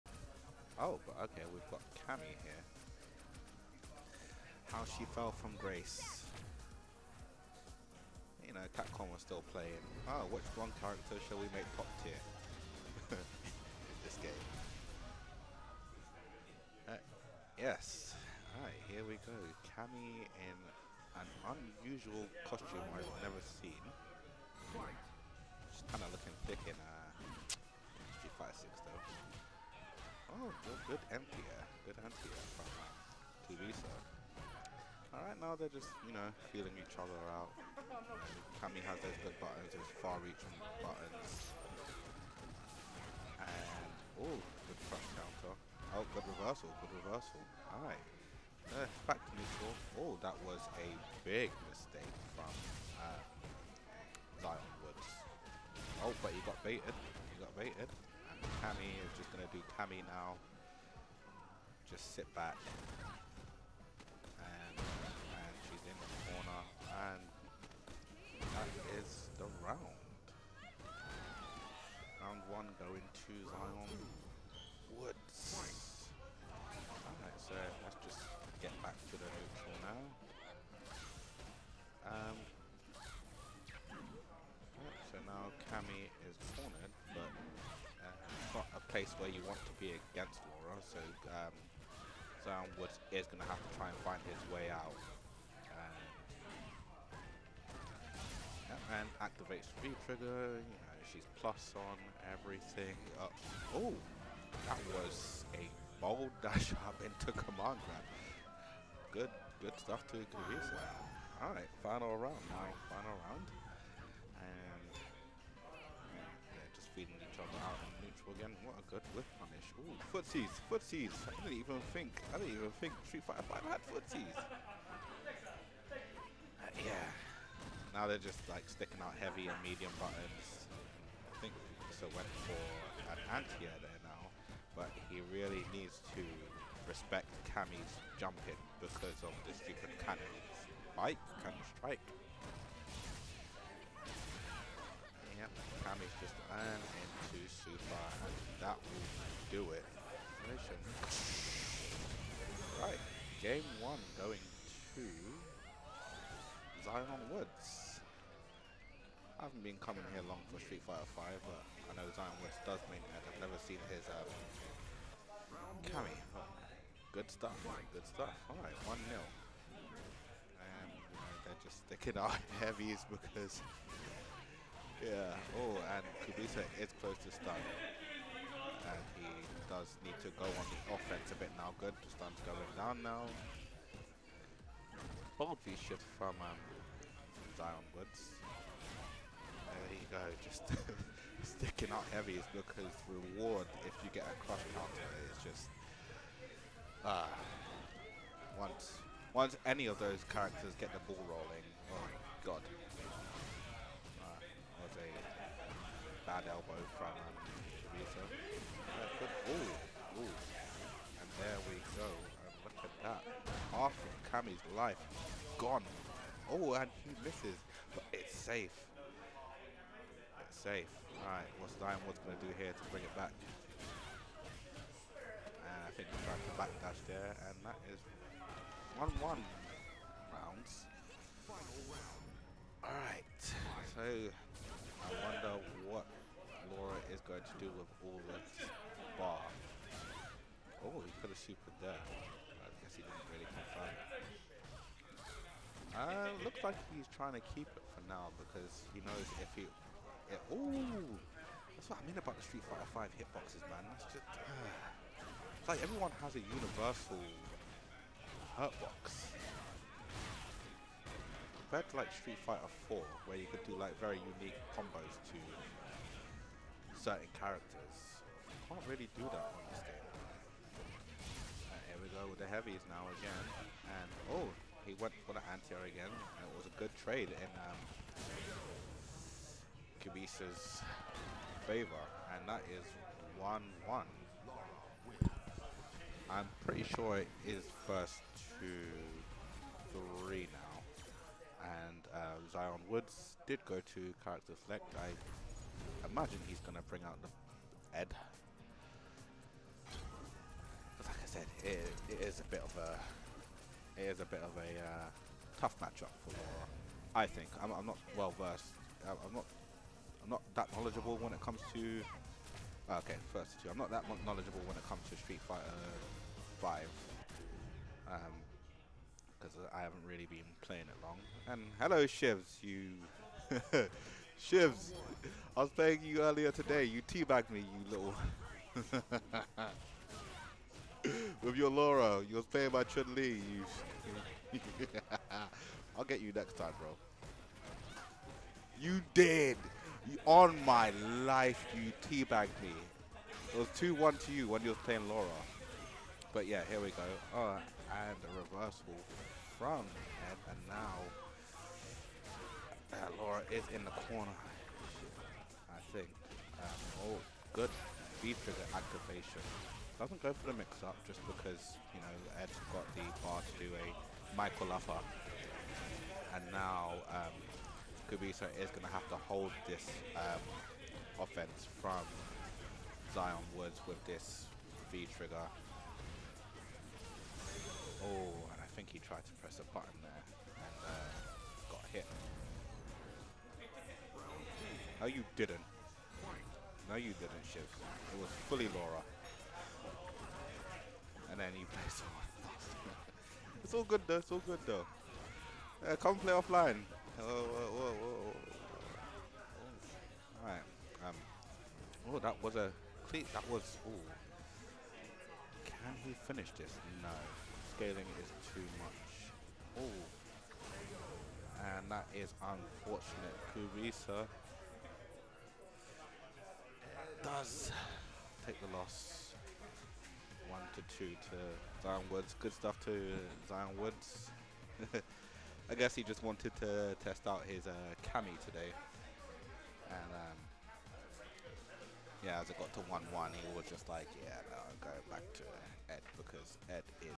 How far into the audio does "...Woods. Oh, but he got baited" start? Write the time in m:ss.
0:54.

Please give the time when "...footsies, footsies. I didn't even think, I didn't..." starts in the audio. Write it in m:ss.
2:00.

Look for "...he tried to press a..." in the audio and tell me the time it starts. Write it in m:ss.
6:18.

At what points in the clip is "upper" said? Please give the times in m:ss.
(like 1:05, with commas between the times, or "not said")
6:04.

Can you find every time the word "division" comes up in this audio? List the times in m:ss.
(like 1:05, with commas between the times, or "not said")
not said.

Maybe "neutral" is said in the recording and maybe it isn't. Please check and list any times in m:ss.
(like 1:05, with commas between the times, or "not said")
0:49, 1:58.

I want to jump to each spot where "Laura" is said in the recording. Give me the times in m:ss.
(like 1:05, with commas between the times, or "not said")
1:30, 5:06, 5:31, 5:45, 5:53, 6:28.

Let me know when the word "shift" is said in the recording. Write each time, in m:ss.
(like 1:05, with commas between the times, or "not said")
3:05.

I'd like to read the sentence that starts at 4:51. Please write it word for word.
And uh, Zion Woods did go to character select.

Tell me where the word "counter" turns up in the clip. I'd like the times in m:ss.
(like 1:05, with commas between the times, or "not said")
0:45, 3:14.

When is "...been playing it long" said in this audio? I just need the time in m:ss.
5:20.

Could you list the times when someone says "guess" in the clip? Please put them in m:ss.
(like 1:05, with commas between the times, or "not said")
4:02, 7:05.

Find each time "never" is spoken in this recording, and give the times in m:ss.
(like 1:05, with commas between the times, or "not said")
0:23, 2:43.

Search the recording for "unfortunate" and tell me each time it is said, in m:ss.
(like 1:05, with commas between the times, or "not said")
6:52.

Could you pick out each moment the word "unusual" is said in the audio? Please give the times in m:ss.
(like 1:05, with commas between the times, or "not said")
0:21.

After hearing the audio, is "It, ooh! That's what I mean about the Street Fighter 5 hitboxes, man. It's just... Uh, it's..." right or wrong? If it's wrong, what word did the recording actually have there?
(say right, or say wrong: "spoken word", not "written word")
right.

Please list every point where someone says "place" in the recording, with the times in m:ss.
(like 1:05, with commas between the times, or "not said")
1:28.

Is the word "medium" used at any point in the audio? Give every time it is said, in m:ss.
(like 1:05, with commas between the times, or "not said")
2:09.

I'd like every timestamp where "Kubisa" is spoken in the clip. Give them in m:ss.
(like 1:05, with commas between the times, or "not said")
1:50, 2:56, 4:39, 6:08, 6:53.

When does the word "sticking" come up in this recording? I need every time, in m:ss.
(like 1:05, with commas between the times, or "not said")
2:08, 2:51, 3:11.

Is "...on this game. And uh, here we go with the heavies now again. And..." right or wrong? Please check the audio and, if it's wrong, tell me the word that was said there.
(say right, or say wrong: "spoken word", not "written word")
right.